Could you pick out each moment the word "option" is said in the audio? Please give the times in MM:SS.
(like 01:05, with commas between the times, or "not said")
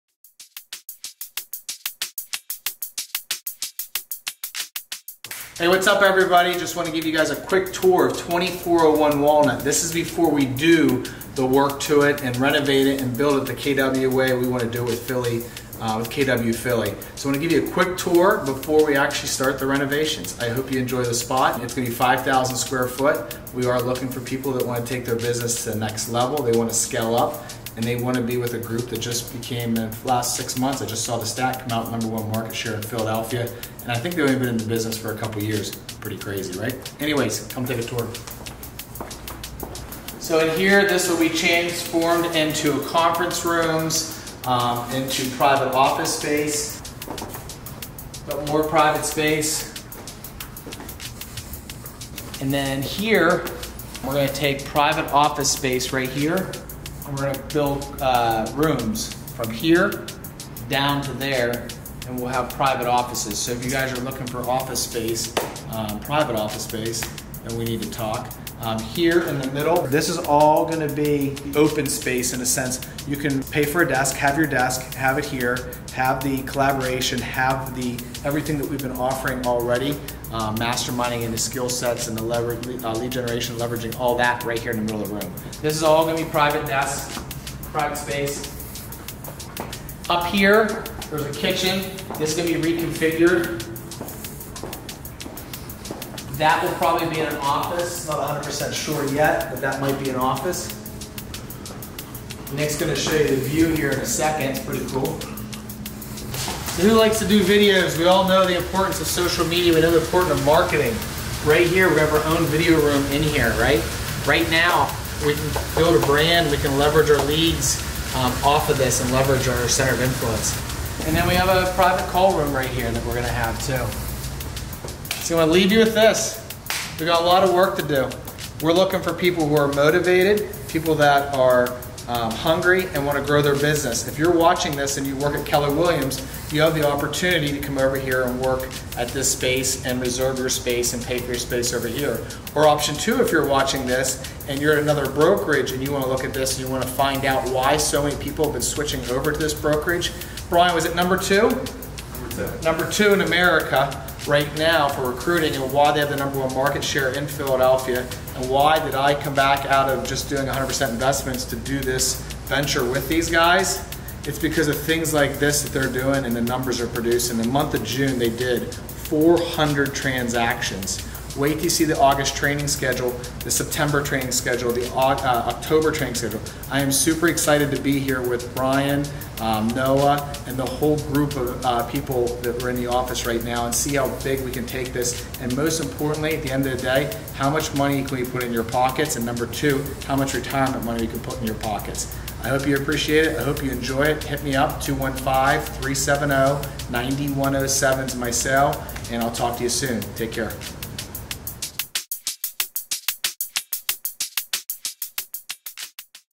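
02:22.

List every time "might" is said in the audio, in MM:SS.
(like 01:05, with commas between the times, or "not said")
01:39.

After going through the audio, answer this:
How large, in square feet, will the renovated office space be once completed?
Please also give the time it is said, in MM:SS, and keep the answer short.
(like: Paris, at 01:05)
5,000 square feet, at 00:21.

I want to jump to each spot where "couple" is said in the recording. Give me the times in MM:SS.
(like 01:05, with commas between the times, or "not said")
00:35.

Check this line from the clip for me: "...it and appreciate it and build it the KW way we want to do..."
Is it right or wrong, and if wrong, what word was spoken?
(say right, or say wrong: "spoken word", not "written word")
wrong: "renovate", not "appreciate".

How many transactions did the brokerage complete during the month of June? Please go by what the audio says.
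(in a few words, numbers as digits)
400.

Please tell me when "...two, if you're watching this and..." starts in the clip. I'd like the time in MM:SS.
02:22.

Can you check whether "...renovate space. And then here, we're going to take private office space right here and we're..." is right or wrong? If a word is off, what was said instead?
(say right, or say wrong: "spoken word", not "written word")
wrong: "private", not "renovate".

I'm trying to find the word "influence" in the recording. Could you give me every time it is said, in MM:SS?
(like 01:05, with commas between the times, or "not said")
02:00.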